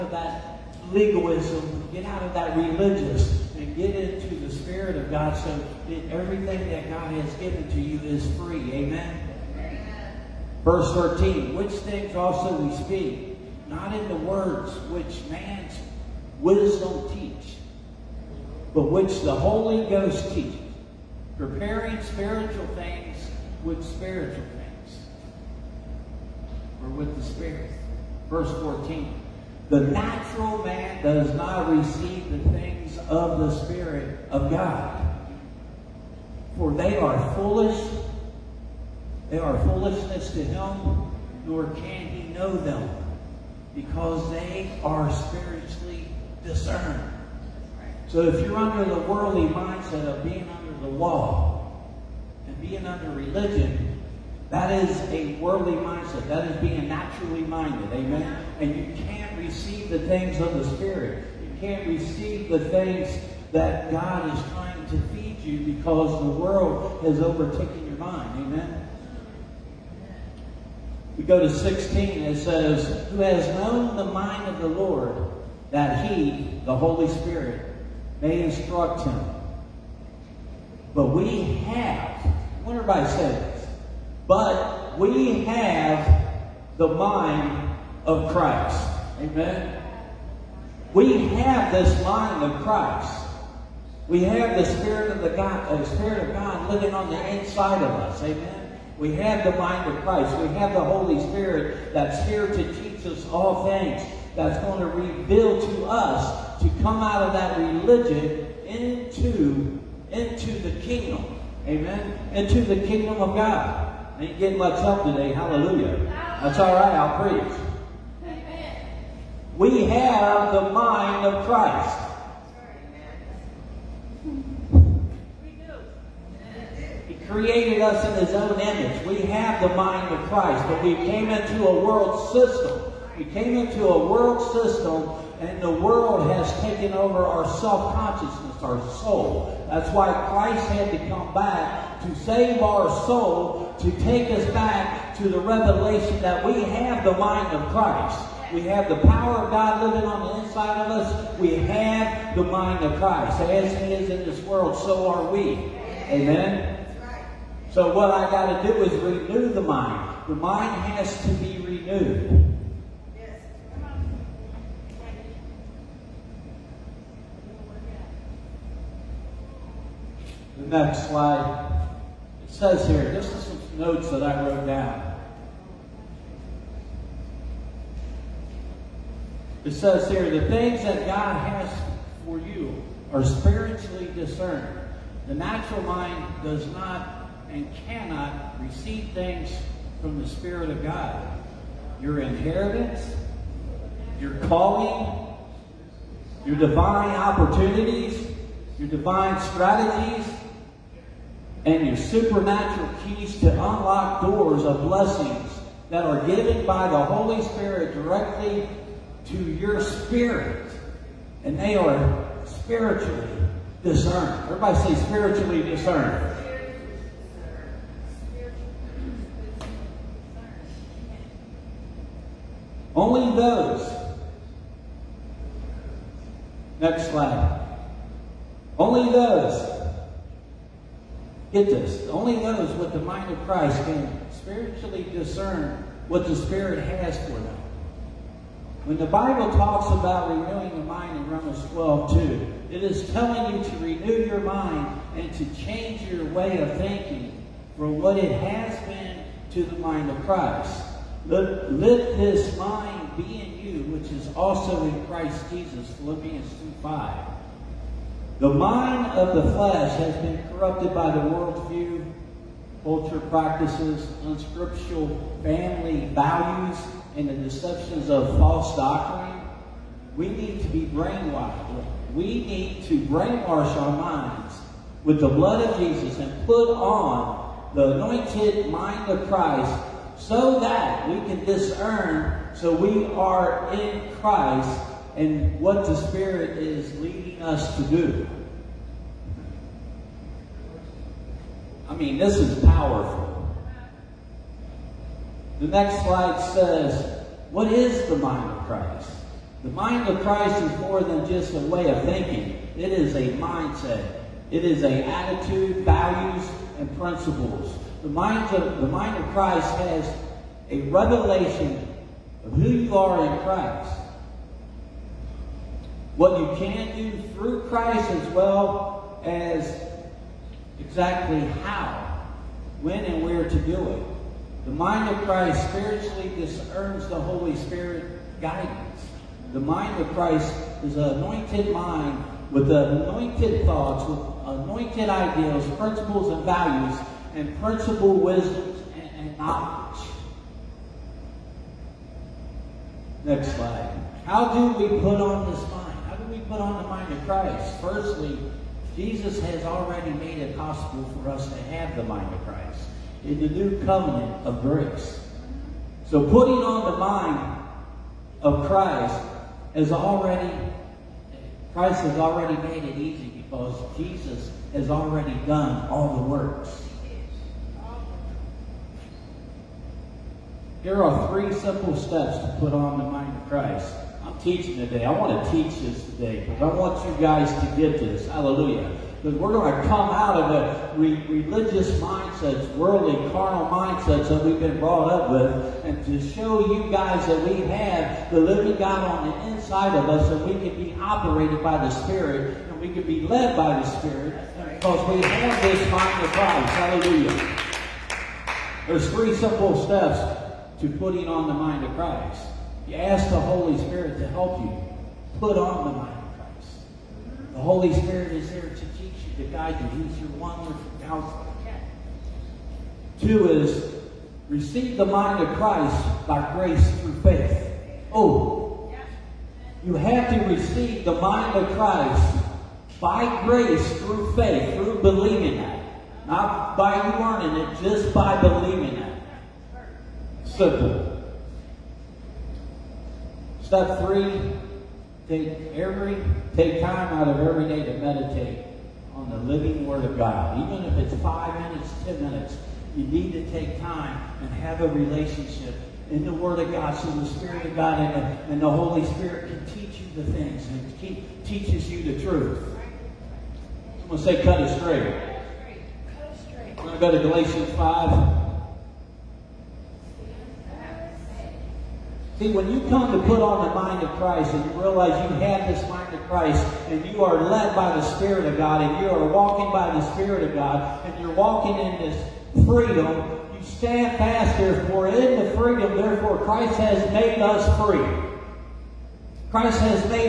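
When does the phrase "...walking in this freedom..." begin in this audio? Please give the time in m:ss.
7:51.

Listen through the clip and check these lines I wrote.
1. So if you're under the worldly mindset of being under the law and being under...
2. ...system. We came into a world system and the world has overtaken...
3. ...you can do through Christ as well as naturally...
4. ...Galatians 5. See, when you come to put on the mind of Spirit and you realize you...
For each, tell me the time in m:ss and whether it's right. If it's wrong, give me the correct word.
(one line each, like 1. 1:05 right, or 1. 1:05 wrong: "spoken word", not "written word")
1. 0:48 right
2. 2:12 wrong: "taken", not "overtaken"
3. 5:16 wrong: "exactly", not "naturally"
4. 7:37 wrong: "Christ", not "Spirit".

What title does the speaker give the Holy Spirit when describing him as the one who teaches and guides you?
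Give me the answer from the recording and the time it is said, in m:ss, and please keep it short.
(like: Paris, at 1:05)
Wonderful counselor, at 6:50.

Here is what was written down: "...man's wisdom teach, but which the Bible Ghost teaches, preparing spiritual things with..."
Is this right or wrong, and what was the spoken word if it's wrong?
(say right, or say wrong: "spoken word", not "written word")
wrong: "Holy", not "Bible".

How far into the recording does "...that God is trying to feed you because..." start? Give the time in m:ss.
1:03.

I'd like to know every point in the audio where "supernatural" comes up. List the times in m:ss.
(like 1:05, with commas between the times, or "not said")
3:21.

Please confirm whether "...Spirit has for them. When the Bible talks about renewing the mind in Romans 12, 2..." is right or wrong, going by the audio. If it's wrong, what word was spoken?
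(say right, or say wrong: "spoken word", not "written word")
right.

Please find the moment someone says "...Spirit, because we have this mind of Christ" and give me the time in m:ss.
6:33.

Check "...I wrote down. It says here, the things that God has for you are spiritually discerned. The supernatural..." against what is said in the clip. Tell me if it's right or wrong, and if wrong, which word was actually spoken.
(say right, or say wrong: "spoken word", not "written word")
wrong: "natural", not "supernatural".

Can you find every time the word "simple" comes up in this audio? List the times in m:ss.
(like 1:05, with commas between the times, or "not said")
6:11, 6:39, 7:10.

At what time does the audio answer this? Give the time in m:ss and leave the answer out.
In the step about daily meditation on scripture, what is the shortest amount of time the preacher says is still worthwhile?
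7:21.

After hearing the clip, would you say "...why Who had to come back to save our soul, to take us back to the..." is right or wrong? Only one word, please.
wrong.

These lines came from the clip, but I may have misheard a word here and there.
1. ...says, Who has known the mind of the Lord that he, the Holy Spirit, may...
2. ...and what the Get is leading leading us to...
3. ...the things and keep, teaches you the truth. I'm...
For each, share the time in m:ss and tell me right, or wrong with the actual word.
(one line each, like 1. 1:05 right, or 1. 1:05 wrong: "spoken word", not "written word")
1. 1:12 right
2. 4:45 wrong: "Spirit", not "Get"
3. 7:30 right.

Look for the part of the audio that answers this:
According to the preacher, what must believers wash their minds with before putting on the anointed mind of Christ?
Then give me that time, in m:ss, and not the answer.
4:35.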